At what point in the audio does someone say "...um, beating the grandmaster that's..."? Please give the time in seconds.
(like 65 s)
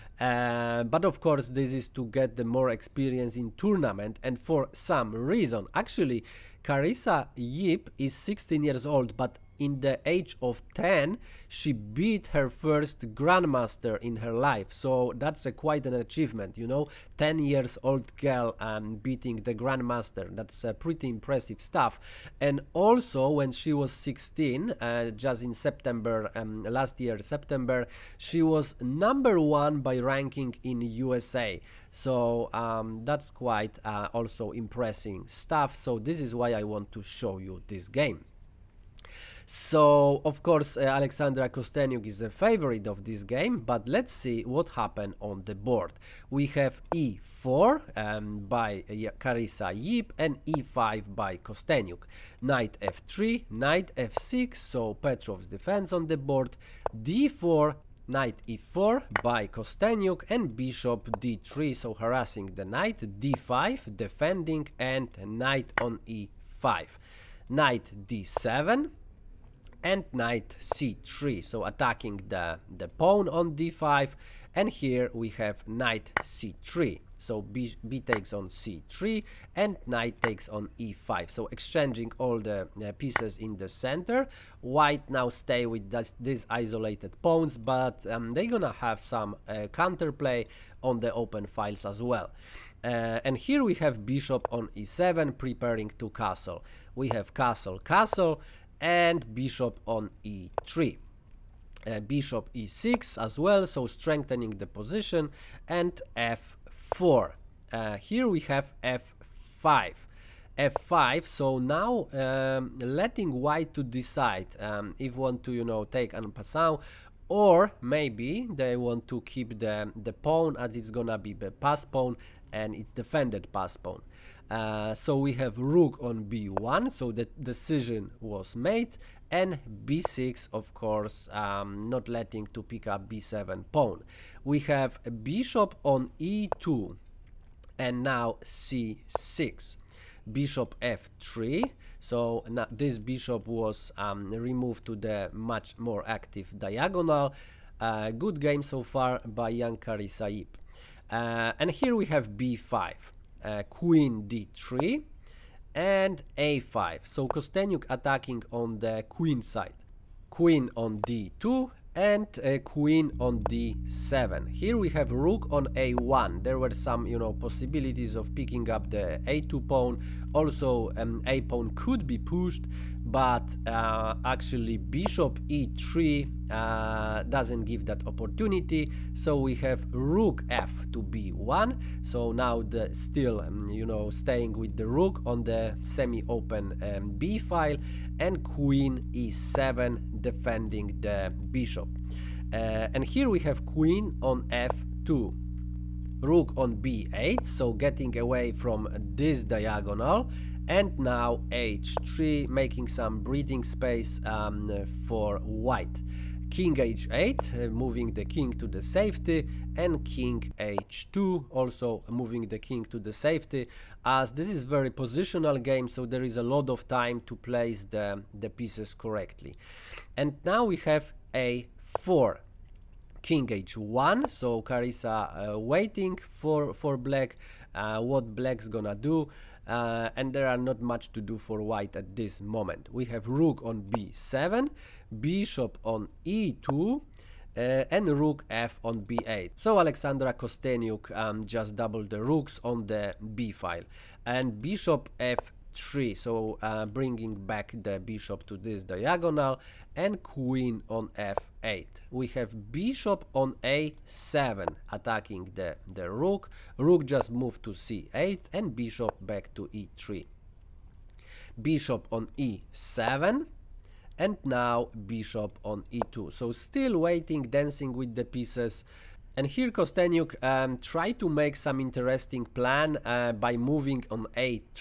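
18 s.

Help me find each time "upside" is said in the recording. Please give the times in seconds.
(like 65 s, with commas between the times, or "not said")
not said.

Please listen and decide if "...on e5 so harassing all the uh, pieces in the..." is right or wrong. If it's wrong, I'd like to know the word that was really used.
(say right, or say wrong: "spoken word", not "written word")
wrong: "exchanging", not "harassing".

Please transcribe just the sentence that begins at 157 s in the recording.
So Kosteniuk attacking on the queen side.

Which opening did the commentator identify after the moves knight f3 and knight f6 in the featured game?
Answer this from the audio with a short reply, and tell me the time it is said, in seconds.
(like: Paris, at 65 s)
Petrov's defense, at 54 s.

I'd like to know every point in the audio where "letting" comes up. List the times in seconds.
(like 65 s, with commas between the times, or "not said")
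112 s, 132 s.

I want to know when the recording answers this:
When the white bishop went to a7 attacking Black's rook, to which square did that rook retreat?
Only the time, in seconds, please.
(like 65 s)
257 s.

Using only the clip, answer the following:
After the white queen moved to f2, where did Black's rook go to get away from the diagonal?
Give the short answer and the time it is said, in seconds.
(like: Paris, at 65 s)
b8, at 196 s.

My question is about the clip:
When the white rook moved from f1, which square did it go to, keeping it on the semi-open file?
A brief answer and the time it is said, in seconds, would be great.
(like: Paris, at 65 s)
b1, at 179 s.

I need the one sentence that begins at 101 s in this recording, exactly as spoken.
Uh, bishop e6 as well, so strengthening the position, and f4.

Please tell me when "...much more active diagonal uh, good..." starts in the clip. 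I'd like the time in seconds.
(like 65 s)
145 s.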